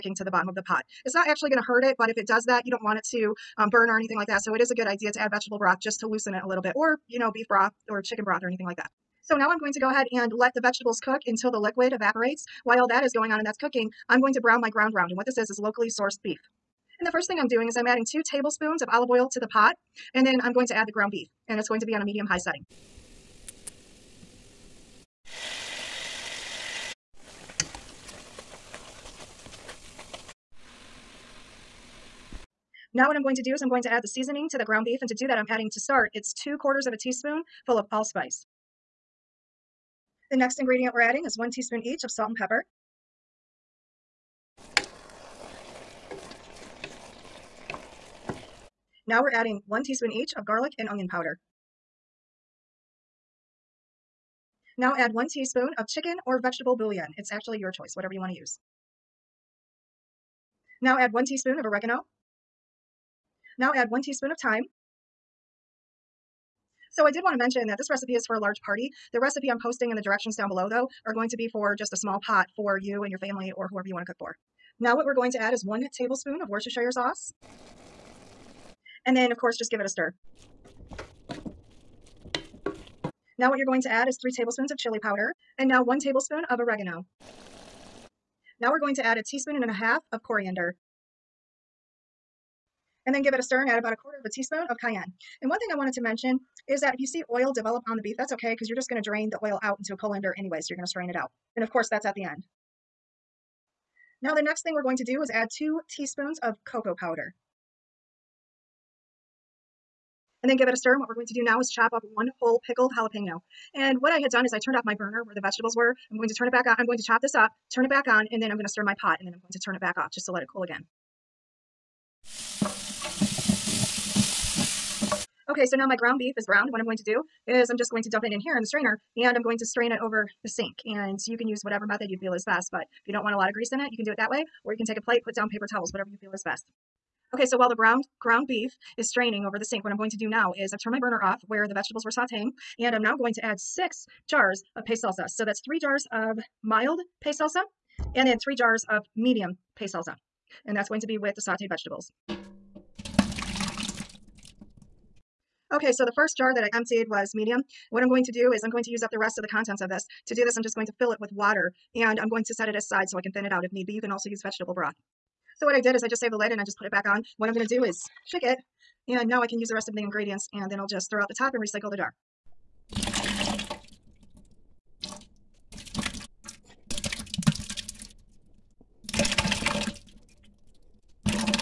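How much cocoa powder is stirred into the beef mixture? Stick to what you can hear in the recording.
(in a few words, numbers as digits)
2 teaspoons.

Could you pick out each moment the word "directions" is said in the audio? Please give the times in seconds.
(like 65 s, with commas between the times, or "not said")
70 s.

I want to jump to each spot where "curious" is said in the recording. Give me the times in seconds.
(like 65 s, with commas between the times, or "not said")
not said.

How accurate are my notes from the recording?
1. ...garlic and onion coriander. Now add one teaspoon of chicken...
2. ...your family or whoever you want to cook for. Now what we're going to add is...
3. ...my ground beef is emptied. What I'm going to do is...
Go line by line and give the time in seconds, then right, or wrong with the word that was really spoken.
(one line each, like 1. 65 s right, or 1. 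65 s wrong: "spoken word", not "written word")
1. 50 s wrong: "powder", not "coriander"
2. 73 s right
3. 125 s wrong: "browned", not "emptied".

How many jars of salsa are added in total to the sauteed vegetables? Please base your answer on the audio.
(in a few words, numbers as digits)
6.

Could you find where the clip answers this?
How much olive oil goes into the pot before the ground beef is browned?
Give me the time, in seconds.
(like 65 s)
18 s.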